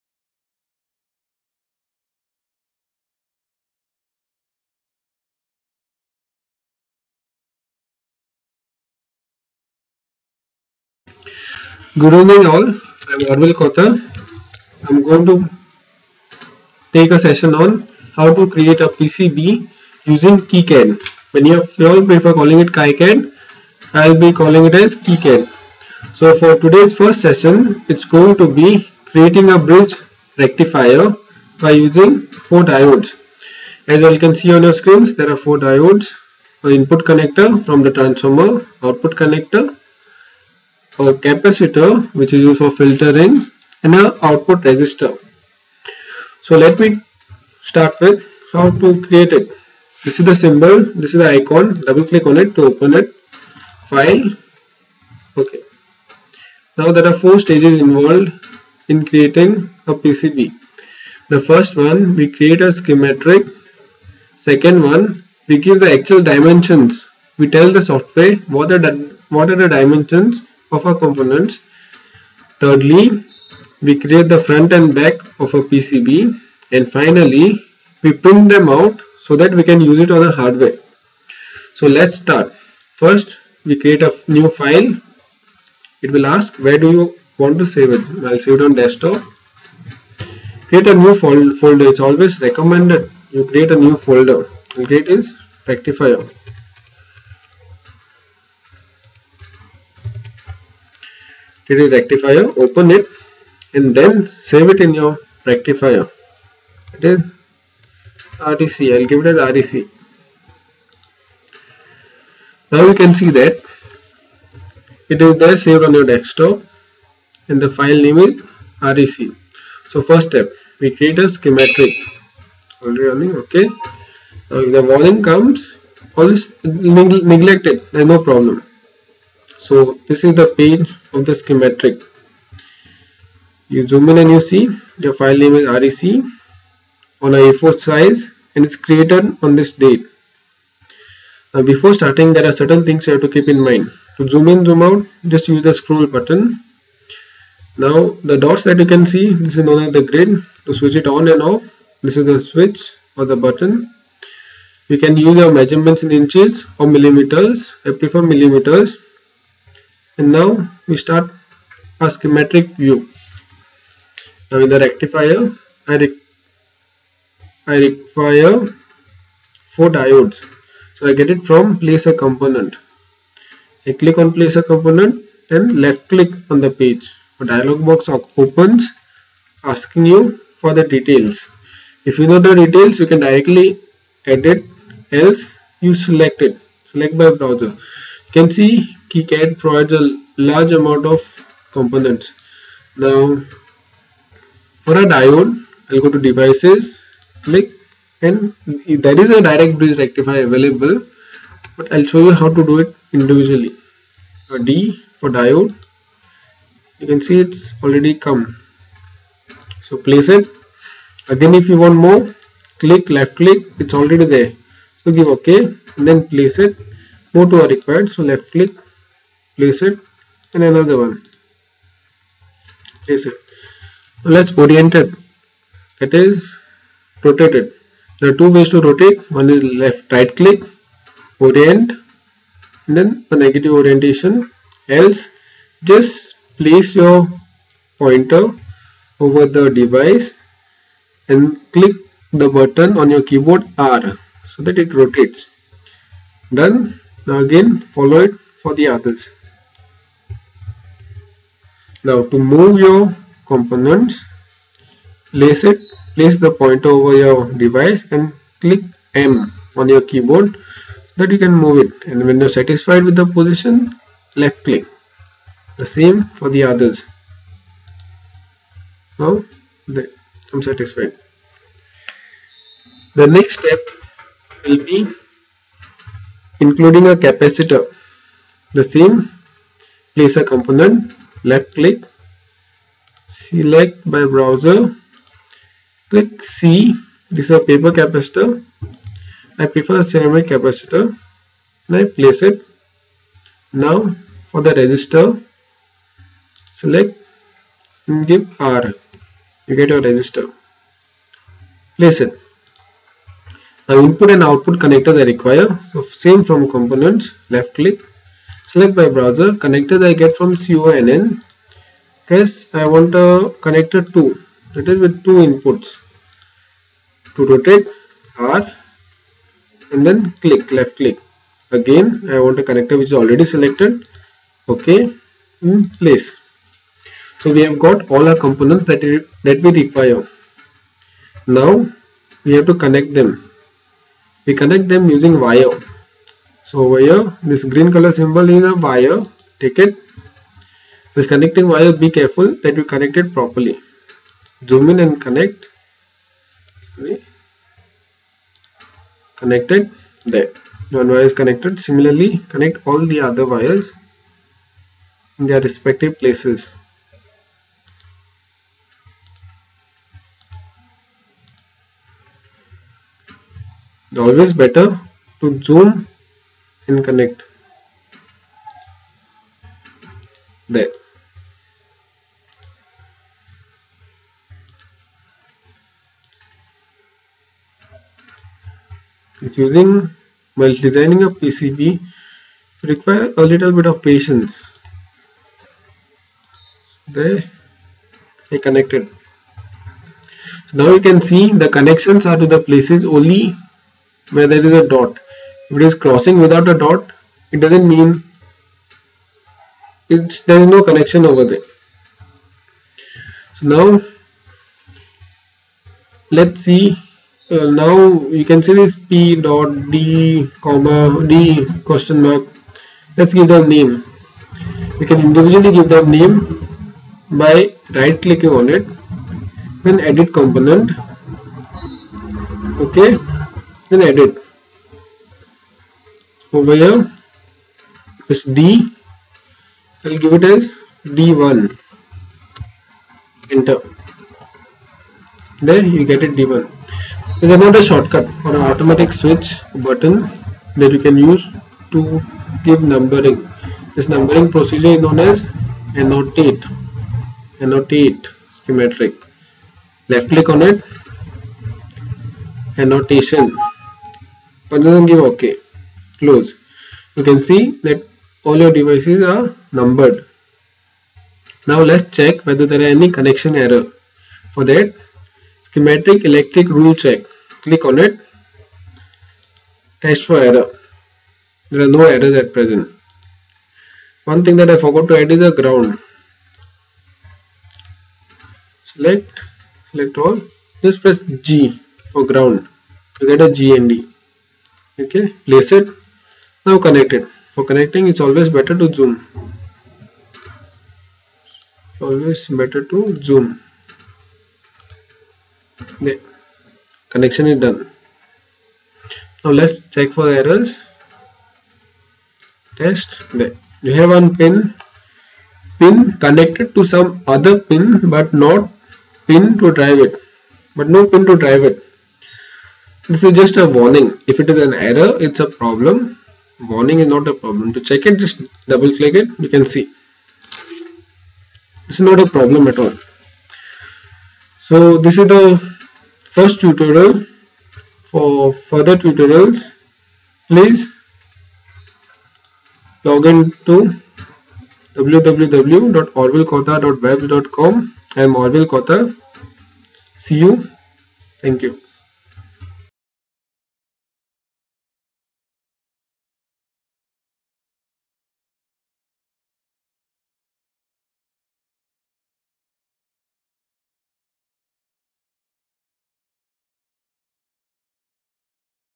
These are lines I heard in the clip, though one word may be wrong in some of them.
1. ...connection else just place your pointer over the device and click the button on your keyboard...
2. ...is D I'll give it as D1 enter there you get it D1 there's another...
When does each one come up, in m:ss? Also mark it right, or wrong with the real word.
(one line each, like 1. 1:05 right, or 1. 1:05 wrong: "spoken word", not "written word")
1. 3:53 wrong: "orientation", not "connection"
2. 7:08 right.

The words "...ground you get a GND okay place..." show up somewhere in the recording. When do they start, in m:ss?
8:02.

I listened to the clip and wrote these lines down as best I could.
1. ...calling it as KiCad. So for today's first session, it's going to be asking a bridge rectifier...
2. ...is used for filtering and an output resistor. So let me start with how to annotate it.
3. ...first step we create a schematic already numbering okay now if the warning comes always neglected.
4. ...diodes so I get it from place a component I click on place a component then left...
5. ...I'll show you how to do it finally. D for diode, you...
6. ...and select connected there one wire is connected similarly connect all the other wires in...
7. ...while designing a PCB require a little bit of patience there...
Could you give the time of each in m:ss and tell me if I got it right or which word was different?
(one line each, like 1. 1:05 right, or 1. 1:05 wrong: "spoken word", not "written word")
1. 0:24 wrong: "creating", not "asking"
2. 0:42 wrong: "create", not "annotate"
3. 2:00 wrong: "running", not "numbering"
4. 2:49 right
5. 3:21 wrong: "individually", not "finally"
6. 5:45 wrong: "connect", not "select"
7. 6:20 right.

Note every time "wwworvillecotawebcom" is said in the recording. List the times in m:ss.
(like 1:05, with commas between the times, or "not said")
8:54.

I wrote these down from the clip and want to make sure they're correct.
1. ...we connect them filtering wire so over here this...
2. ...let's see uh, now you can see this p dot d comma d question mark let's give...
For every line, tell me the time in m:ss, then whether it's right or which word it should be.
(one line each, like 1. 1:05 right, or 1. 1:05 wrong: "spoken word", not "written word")
1. 5:34 wrong: "using", not "filtering"
2. 6:46 right.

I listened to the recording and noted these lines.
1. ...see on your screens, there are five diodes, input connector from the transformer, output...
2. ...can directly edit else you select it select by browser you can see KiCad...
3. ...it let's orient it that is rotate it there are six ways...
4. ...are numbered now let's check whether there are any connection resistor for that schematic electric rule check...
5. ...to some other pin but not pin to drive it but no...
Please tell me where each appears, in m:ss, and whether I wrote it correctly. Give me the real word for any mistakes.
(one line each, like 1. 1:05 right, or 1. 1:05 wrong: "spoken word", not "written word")
1. 0:34 wrong: "four", not "five"
2. 3:03 right
3. 3:43 wrong: "two", not "six"
4. 7:39 wrong: "error", not "resistor"
5. 8:26 right.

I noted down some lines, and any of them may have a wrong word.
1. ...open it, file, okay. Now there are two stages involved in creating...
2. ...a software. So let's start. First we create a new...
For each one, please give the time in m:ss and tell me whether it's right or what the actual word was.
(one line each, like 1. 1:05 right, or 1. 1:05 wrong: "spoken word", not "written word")
1. 0:52 wrong: "four", not "two"
2. 1:20 wrong: "hardware", not "software".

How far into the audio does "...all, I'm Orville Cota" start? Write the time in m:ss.
0:12.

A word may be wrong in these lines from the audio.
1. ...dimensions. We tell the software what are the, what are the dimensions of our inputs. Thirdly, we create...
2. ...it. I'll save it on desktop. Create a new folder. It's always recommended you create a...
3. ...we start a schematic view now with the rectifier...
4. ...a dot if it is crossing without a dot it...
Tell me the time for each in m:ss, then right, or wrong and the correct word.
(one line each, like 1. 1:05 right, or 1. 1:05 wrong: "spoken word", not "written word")
1. 1:06 wrong: "components", not "inputs"
2. 1:27 right
3. 2:40 right
4. 6:34 right.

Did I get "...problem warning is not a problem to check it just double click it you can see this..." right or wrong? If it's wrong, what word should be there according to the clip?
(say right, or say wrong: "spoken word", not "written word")
right.